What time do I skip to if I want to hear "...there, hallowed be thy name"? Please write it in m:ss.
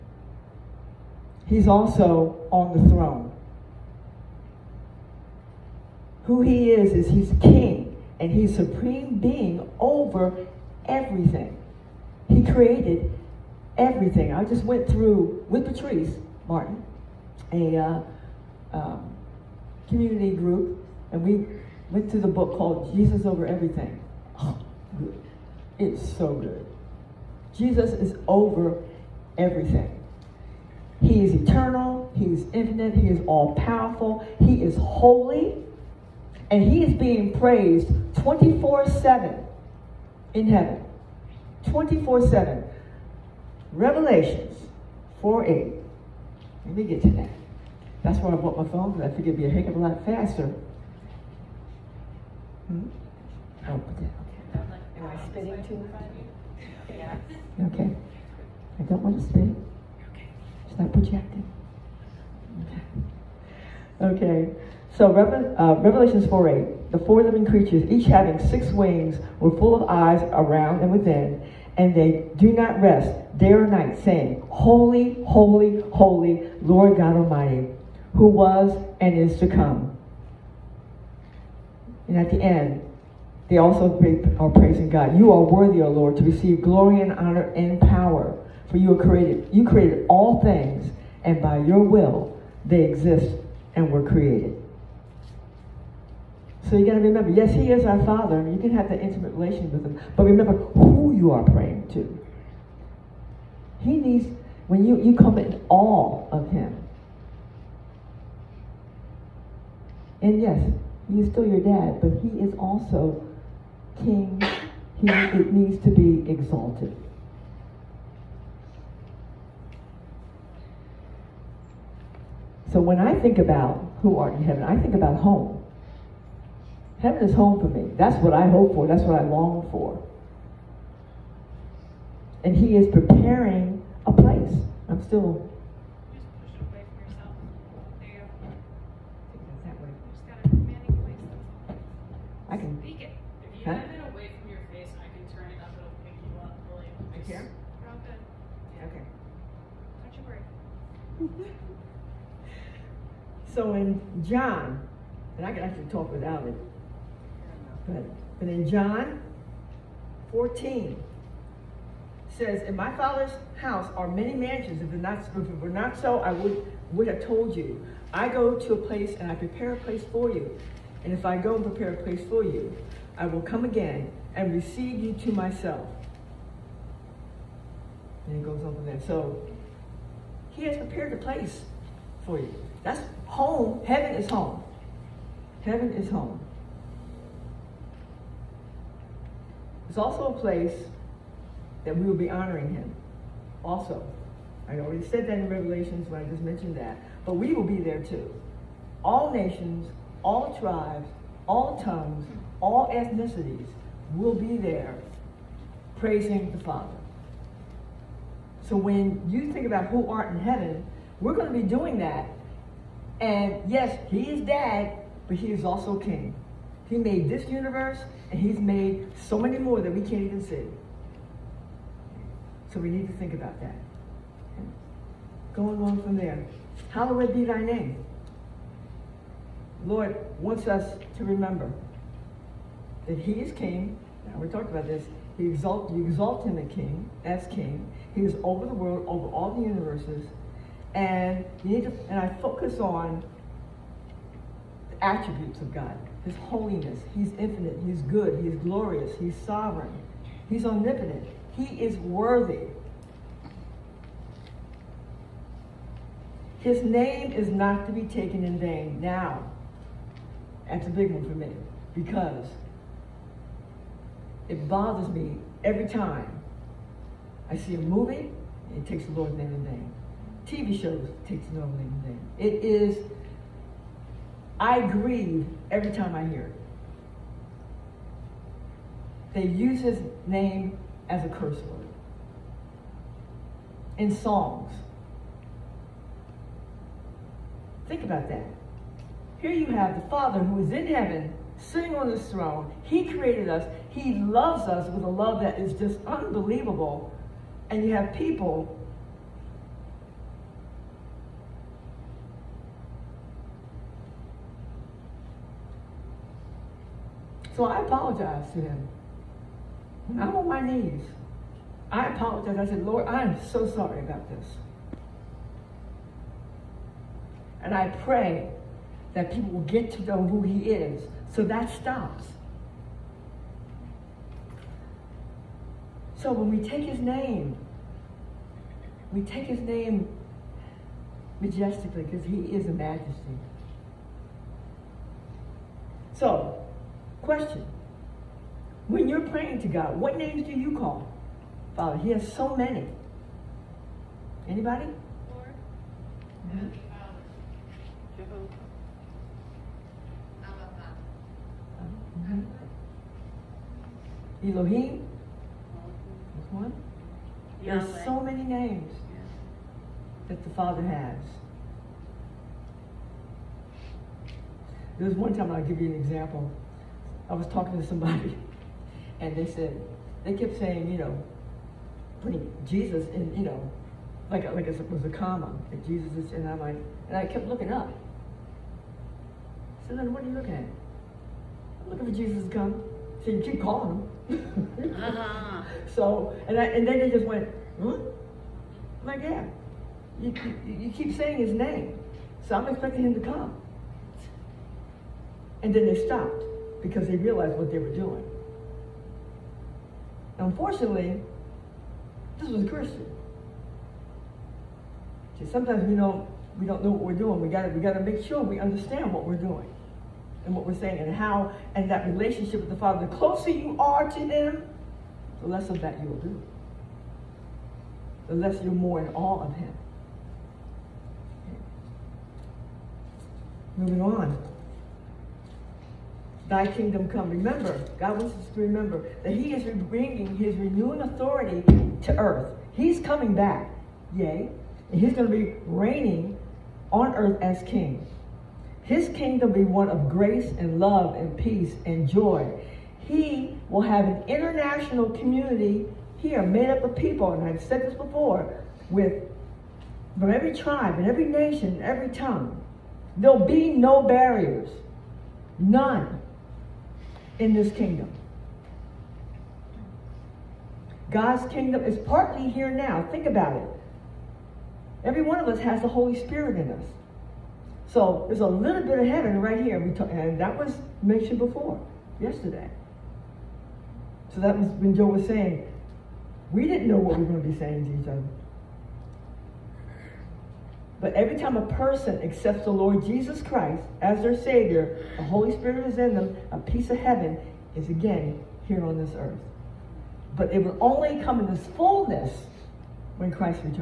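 3:46.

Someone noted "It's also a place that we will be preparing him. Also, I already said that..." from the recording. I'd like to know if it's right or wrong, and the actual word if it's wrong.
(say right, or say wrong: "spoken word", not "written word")
wrong: "honoring", not "preparing".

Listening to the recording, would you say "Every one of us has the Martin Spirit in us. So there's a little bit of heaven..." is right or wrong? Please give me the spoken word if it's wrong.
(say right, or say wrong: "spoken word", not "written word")
wrong: "Holy", not "Martin".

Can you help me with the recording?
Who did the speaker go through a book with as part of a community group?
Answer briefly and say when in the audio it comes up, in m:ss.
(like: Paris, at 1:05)
Patrice Martin, at 0:15.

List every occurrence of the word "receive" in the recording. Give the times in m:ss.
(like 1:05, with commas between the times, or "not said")
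1:26, 2:54.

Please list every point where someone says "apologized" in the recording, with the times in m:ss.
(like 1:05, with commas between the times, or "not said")
5:07, 5:12.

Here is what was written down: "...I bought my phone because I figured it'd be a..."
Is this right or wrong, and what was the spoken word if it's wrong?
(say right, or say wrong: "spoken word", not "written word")
right.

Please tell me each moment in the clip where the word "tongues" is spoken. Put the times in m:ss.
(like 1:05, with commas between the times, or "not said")
3:21, 7:32.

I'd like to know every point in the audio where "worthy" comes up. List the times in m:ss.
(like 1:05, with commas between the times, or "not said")
1:25, 4:11.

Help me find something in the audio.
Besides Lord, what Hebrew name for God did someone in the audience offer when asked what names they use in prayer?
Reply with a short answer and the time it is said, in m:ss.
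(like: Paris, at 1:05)
Elohim, at 5:54.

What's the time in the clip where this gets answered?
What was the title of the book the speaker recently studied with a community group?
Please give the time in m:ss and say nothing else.
0:22.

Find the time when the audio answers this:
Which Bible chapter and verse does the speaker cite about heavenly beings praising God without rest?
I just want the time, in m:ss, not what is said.
1:05.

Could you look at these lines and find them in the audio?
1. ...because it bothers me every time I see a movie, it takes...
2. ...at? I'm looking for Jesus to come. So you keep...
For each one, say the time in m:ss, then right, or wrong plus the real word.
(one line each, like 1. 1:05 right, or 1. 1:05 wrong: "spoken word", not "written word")
1. 4:21 right
2. 6:20 right.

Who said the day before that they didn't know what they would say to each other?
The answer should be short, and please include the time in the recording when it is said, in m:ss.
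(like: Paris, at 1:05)
Joe, at 7:54.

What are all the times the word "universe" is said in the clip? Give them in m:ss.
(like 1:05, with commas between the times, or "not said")
3:37, 3:59.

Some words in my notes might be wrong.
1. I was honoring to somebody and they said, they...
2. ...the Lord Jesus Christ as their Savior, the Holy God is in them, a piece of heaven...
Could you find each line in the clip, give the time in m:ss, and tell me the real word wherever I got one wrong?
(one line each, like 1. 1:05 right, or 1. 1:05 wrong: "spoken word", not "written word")
1. 6:07 wrong: "talking", not "honoring"
2. 8:02 wrong: "Spirit", not "God".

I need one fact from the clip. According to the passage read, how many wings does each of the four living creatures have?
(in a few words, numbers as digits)
6.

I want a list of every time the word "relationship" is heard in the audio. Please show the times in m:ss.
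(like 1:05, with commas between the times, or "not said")
1:39, 6:52.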